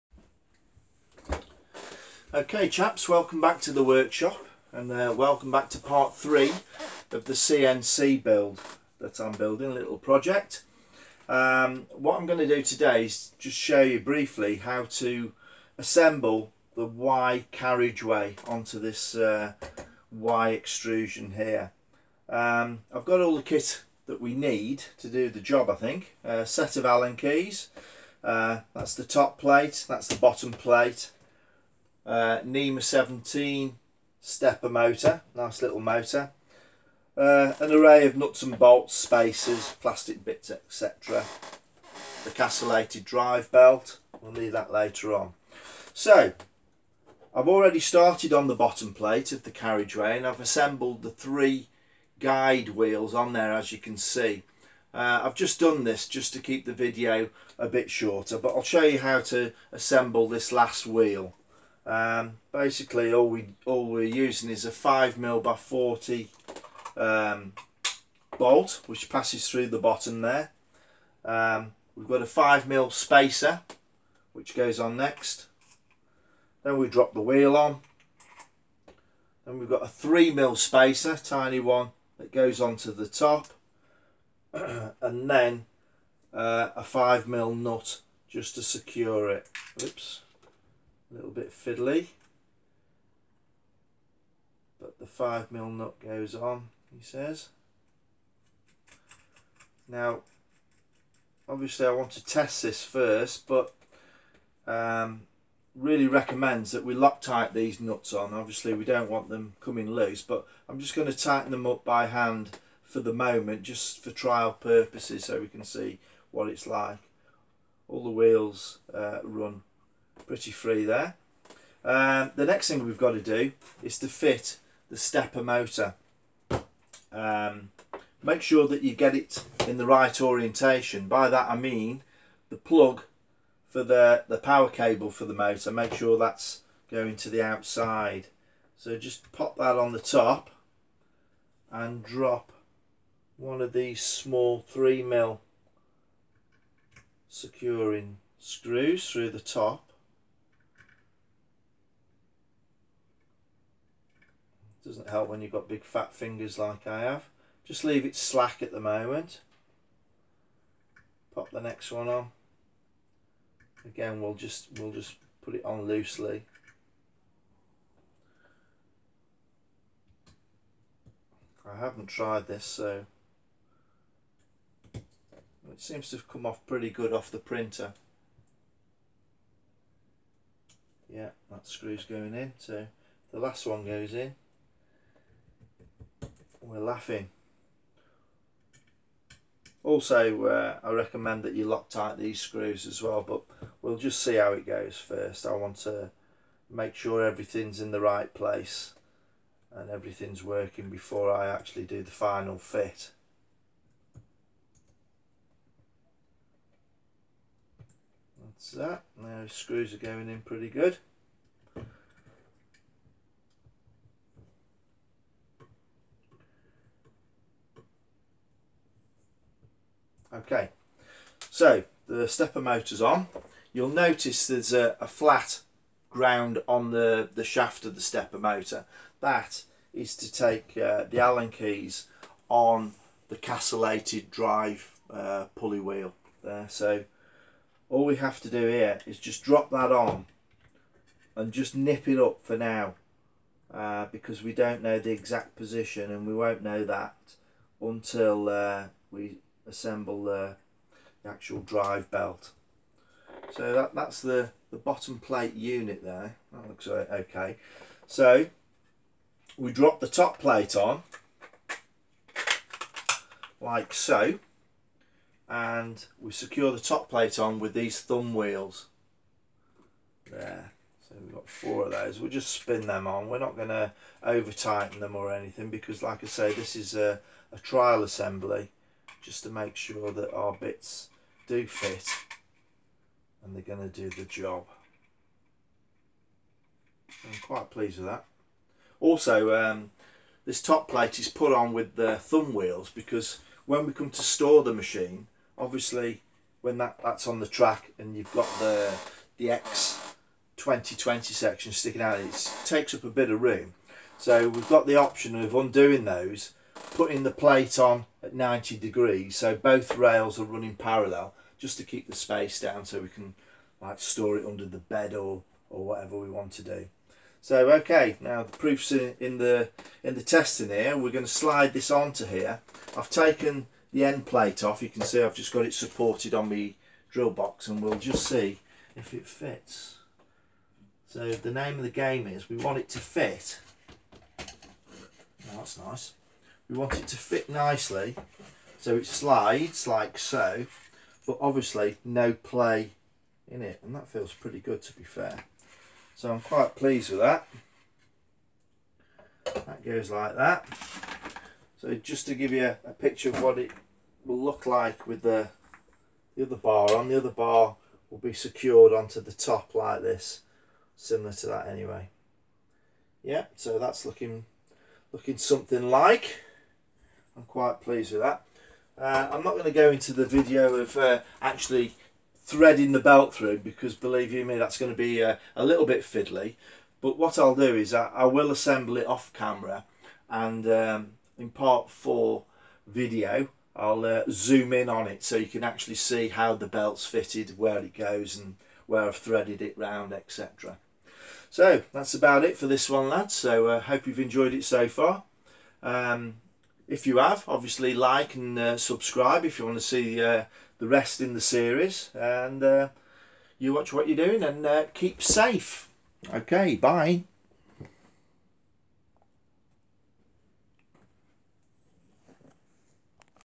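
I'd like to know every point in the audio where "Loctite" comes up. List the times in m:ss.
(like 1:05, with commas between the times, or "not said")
1:46, 3:11.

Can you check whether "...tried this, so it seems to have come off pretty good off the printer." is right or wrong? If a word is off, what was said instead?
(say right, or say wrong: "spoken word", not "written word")
right.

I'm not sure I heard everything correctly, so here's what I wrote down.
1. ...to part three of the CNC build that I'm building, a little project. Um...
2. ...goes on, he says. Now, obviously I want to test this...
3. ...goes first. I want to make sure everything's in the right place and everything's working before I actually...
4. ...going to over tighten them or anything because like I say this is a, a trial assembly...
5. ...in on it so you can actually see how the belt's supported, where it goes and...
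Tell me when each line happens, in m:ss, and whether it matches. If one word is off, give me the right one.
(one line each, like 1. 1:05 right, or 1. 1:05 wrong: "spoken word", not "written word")
1. 0:05 right
2. 1:36 right
3. 3:14 right
4. 4:33 right
5. 6:24 wrong: "fitted", not "supported".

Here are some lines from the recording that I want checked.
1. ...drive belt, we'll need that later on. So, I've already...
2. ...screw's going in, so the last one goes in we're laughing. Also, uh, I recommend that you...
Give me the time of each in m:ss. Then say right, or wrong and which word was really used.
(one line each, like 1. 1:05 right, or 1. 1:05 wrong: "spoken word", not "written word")
1. 0:43 right
2. 3:01 right.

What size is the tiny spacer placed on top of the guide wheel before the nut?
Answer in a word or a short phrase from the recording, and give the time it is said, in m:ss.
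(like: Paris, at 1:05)
3mm, at 1:19.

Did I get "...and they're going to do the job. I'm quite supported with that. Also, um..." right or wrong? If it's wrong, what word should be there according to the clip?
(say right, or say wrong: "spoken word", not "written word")
wrong: "pleased", not "supported".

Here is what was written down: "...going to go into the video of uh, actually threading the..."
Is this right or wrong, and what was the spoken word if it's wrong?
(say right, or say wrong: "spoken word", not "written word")
right.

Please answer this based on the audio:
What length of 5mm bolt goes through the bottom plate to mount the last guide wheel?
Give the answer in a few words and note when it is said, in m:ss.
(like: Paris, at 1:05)
40, at 1:05.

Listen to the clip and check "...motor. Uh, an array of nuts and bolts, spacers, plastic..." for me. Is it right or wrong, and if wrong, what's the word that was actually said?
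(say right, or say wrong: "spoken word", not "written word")
right.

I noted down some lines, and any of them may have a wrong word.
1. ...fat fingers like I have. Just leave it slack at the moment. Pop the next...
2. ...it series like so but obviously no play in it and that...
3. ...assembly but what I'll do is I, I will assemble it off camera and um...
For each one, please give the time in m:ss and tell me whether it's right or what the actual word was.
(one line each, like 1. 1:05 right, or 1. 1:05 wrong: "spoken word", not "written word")
1. 2:35 right
2. 5:38 wrong: "slides", not "series"
3. 6:16 wrong: "fiddly", not "assembly".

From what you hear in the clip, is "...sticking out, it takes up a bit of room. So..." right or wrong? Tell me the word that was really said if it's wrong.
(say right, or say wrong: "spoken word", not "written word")
right.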